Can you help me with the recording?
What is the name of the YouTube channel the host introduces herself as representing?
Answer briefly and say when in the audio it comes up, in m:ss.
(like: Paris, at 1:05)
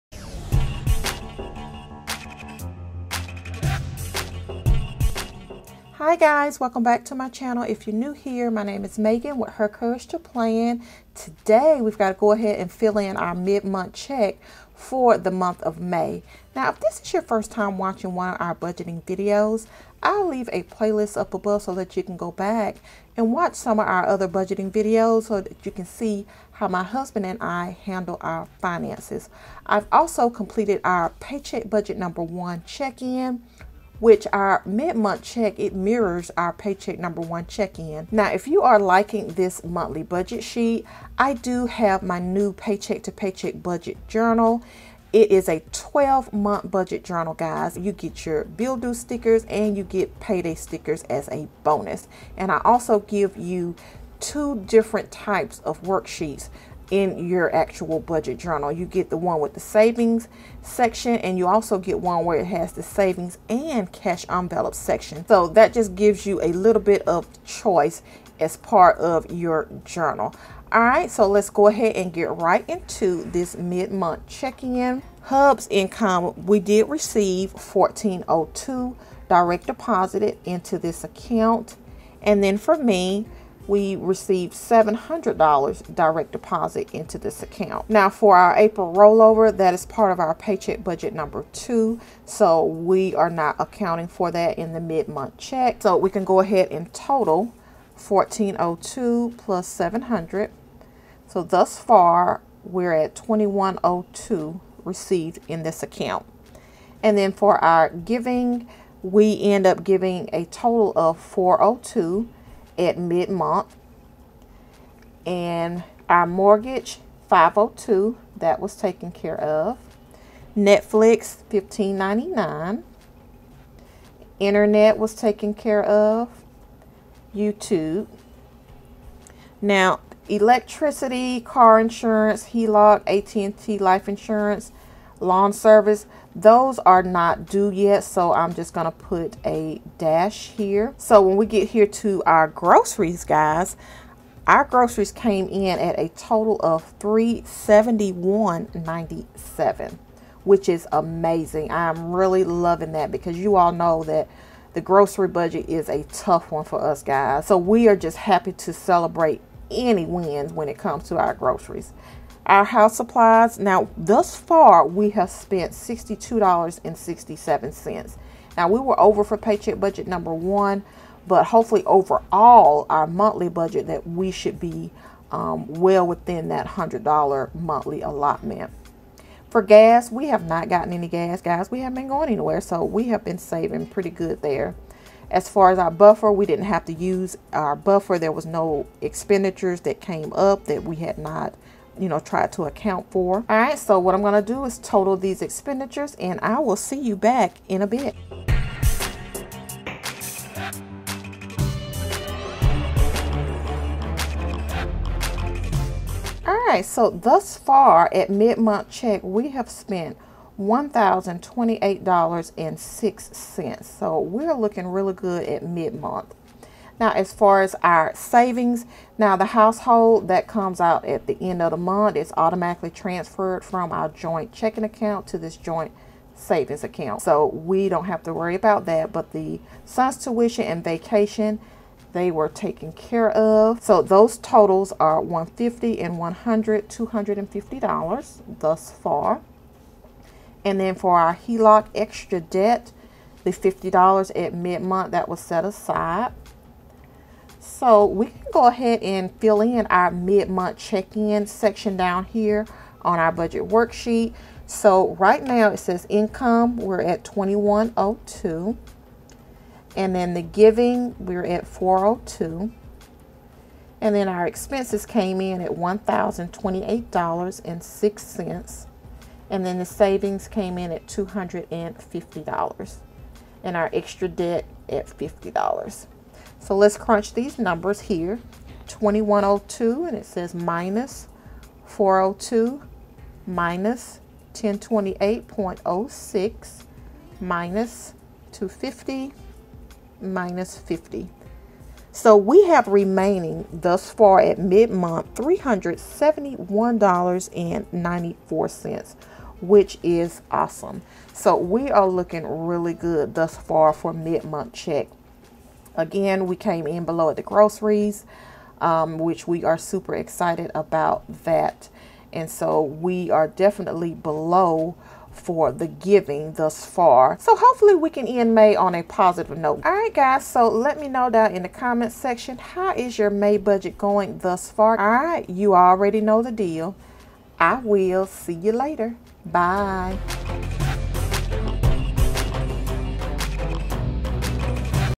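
Her Courage to Plan, at 0:09.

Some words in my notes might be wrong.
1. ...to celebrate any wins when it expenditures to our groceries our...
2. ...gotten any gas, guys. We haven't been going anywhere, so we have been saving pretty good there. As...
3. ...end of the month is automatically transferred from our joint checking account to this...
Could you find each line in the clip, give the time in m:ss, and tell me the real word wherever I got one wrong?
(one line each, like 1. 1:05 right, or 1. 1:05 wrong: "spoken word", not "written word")
1. 2:38 wrong: "comes", not "expenditures"
2. 3:00 right
3. 3:41 right.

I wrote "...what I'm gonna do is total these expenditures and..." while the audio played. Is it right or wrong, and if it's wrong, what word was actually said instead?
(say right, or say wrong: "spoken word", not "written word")
right.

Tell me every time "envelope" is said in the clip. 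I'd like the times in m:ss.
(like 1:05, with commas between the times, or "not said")
1:04.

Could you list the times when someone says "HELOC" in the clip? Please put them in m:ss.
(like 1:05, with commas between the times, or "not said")
2:12, 4:01.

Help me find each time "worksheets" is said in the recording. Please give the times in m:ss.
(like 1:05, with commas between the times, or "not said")
0:55, 4:13.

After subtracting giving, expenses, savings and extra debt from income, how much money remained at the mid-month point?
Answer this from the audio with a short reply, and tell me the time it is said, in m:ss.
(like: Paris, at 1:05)
$371.94, at 4:55.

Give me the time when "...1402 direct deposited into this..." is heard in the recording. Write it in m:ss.
1:17.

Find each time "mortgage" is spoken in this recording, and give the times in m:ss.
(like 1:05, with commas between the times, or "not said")
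1:56.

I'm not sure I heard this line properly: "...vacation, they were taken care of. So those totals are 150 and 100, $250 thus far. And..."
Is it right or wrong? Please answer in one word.
right.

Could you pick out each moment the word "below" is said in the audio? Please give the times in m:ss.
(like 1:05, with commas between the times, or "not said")
5:07, 5:14.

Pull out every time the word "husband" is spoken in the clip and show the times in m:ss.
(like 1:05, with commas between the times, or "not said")
0:26.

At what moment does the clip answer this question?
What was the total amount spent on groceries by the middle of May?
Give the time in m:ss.
2:26.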